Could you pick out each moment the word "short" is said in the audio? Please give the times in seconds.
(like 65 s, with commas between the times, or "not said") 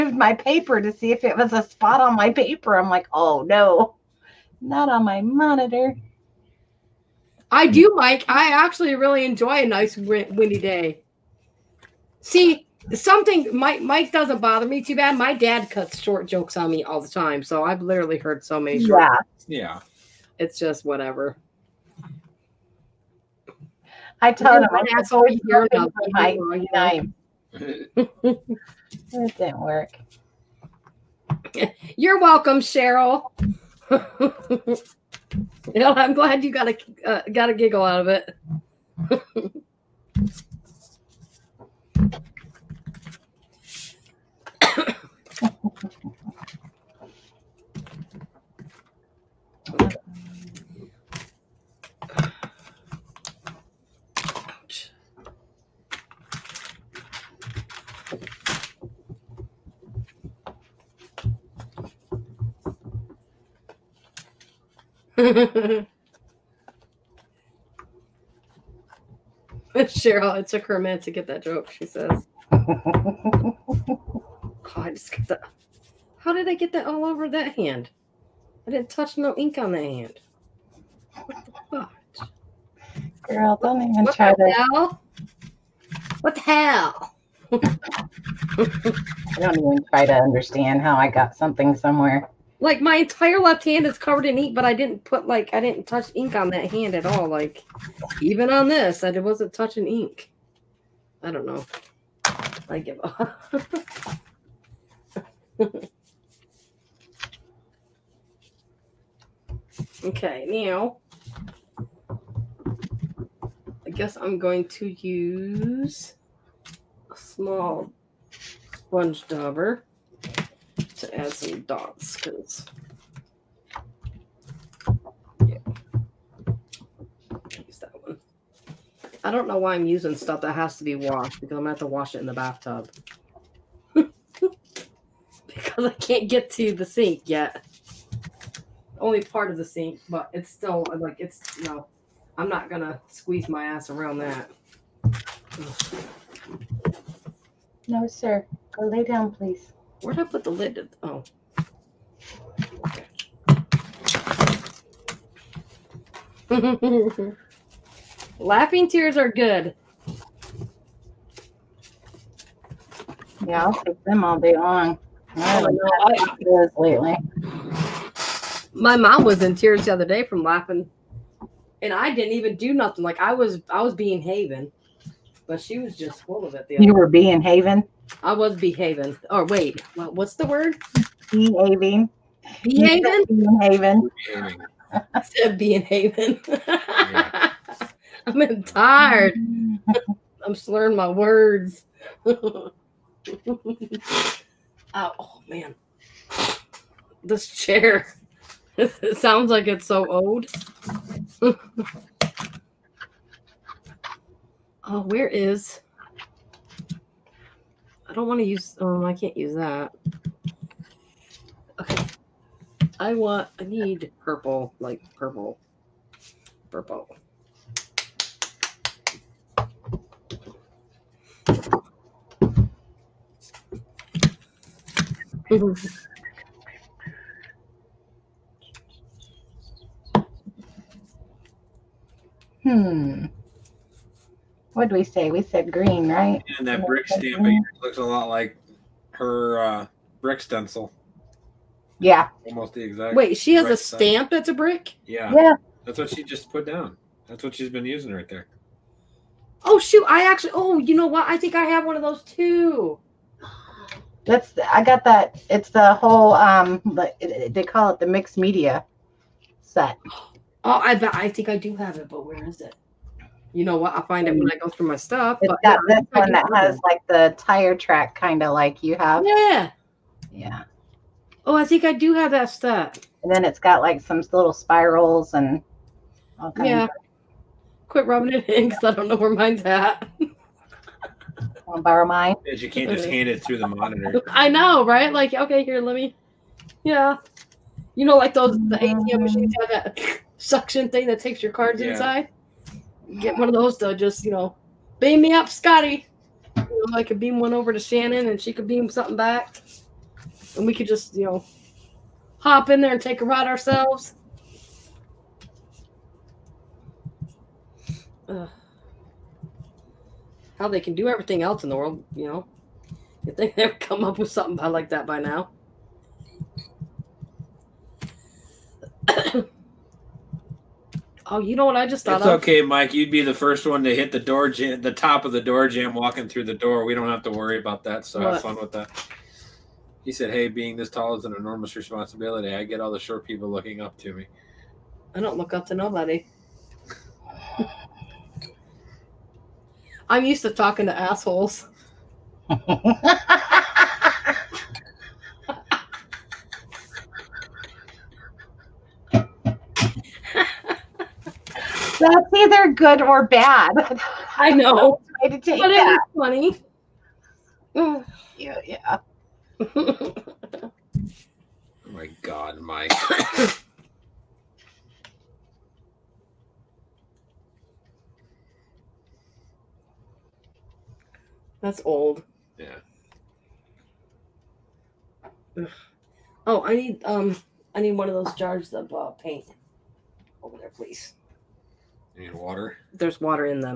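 15 s, 332 s.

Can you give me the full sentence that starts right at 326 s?
We don't have to worry about that.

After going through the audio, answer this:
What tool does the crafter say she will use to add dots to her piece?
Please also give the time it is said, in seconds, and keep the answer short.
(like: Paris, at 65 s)
small sponge dauber, at 117 s.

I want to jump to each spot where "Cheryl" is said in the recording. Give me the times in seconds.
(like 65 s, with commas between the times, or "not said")
32 s, 69 s.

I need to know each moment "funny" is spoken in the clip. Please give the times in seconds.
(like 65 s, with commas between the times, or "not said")
356 s.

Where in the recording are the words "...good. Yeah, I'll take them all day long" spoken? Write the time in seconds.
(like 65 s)
159 s.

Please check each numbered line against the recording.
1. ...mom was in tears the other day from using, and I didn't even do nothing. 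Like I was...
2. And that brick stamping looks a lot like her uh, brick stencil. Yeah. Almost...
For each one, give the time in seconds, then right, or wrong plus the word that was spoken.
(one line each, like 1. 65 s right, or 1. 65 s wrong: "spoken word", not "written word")
1. 168 s wrong: "laughing", not "using"
2. 236 s right.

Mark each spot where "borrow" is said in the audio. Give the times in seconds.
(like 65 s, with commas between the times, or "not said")
281 s.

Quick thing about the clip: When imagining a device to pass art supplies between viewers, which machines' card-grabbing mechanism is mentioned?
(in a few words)
ATM machines.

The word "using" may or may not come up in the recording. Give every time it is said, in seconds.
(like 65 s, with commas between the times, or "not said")
129 s, 247 s.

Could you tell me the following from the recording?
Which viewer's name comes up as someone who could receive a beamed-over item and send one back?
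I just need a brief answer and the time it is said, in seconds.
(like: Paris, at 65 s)
Shannon, at 297 s.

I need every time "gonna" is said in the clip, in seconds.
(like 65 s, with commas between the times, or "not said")
131 s, 142 s.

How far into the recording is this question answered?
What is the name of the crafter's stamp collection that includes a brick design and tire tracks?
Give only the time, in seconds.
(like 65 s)
258 s.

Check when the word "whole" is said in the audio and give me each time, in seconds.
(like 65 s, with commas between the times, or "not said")
255 s.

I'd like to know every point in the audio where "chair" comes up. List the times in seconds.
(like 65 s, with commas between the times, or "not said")
197 s.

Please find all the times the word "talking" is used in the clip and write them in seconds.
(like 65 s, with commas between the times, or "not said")
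340 s.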